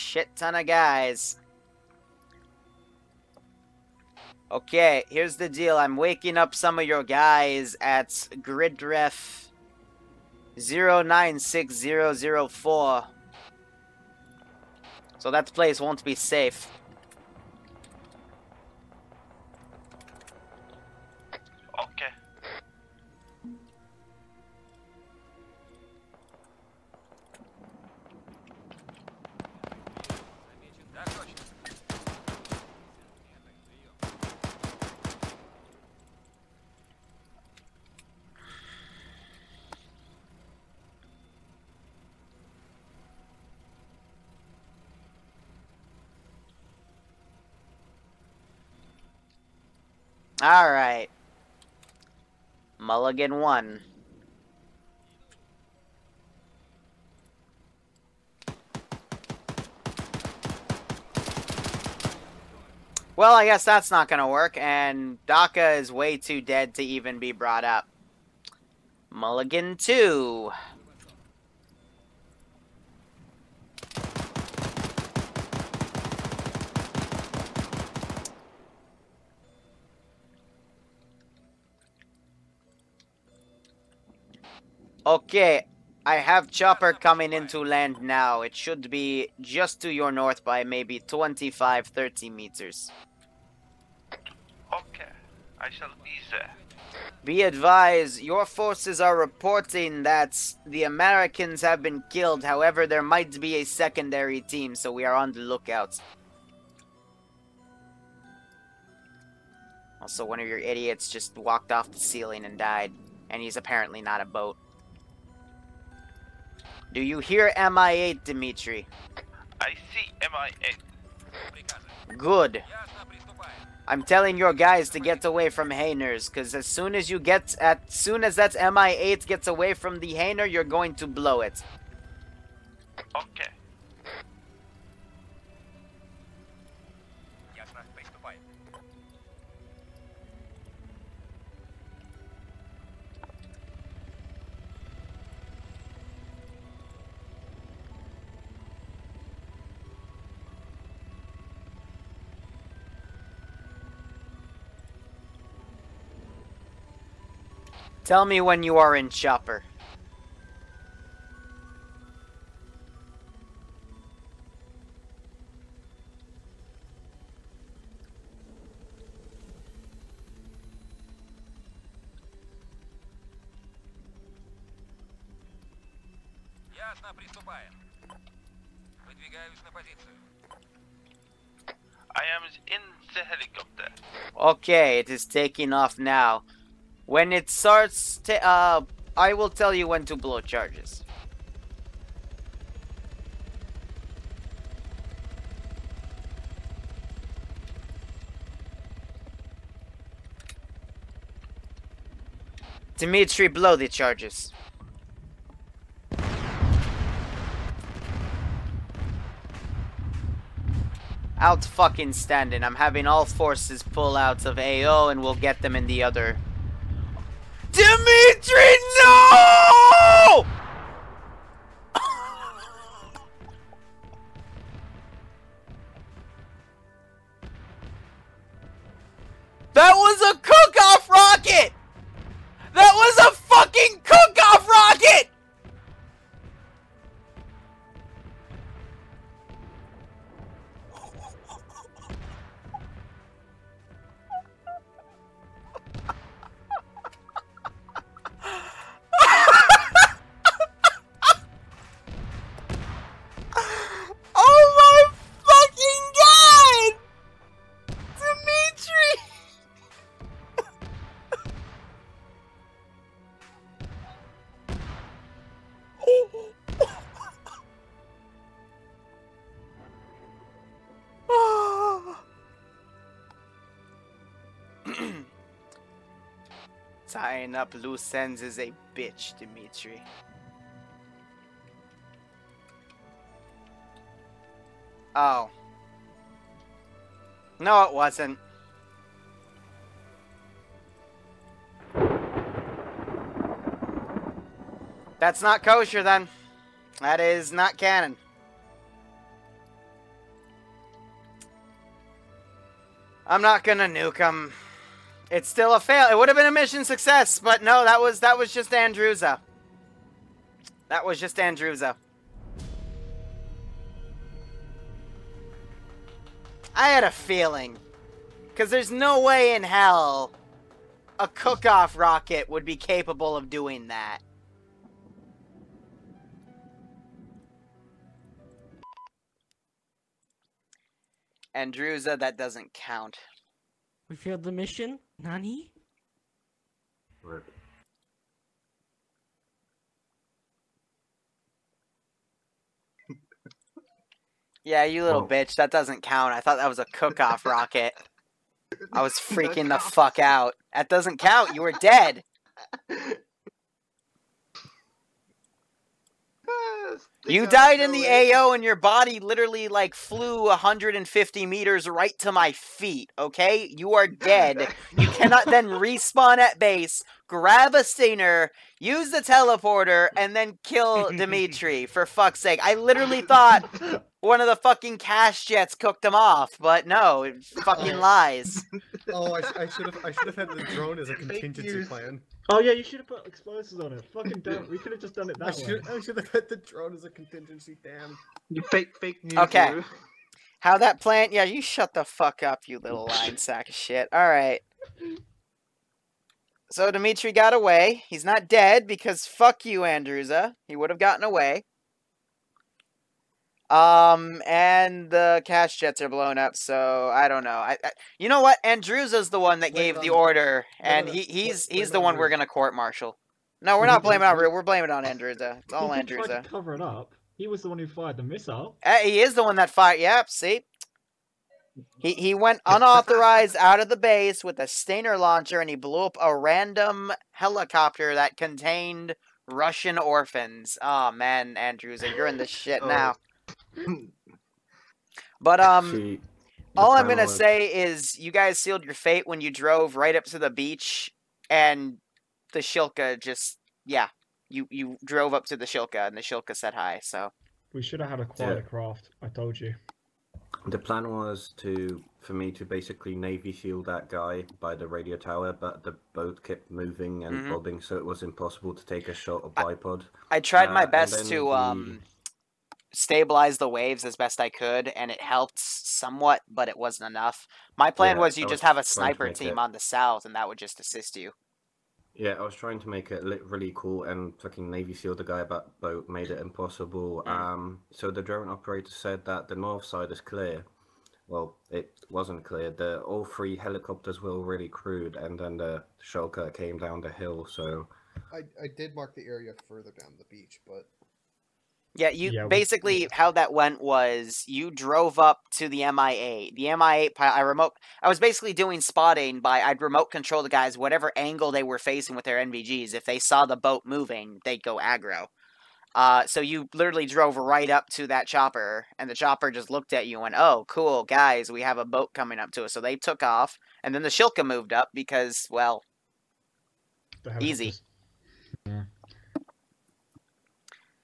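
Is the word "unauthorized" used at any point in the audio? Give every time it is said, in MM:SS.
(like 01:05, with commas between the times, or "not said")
07:02.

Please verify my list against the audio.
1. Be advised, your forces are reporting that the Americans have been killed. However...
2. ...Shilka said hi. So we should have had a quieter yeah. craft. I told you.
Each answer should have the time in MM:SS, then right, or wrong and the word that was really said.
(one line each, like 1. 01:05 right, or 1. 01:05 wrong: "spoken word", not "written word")
1. 01:37 right
2. 07:26 right.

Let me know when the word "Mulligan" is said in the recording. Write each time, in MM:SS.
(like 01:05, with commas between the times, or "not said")
00:52, 01:09.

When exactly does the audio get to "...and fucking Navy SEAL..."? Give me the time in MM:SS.
07:54.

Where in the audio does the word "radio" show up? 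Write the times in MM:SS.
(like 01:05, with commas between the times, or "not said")
07:34.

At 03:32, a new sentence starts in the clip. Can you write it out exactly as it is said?
I'm having all forces pull out of AO and we'll get them in the other Dimitri, no!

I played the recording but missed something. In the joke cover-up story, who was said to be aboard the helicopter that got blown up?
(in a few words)
Russian orphans.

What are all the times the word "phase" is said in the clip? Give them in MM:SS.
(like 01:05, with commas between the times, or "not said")
not said.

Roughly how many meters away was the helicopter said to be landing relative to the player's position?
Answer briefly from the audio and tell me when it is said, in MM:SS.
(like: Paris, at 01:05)
25 to 30 meters, at 01:30.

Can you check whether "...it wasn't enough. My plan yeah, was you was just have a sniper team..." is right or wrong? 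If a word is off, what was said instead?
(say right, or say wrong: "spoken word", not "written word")
right.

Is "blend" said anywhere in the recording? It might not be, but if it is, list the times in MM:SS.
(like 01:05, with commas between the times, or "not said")
not said.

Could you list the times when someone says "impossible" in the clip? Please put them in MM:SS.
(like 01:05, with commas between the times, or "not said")
07:38, 07:56.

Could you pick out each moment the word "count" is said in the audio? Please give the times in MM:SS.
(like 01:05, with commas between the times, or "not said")
05:32, 05:46, 05:51.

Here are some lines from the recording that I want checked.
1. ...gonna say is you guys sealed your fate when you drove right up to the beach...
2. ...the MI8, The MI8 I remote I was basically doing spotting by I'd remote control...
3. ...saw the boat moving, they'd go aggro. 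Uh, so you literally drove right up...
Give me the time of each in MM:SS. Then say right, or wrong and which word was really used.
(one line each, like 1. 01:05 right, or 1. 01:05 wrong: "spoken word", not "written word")
1. 07:17 right
2. 08:15 right
3. 08:23 right.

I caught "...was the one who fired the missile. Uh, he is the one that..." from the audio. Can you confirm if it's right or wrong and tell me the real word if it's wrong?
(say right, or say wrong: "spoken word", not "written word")
right.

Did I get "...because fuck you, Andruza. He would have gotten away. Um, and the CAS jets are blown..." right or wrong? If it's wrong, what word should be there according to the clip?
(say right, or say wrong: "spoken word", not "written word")
right.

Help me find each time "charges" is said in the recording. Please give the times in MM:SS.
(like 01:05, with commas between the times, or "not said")
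03:10, 03:23.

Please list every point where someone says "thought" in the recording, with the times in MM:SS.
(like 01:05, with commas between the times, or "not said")
05:46, 06:13.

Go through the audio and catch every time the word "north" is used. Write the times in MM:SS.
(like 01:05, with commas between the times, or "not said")
01:30, 07:59.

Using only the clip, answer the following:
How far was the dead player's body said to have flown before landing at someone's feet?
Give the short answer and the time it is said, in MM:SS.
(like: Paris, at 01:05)
150 meters, at 06:00.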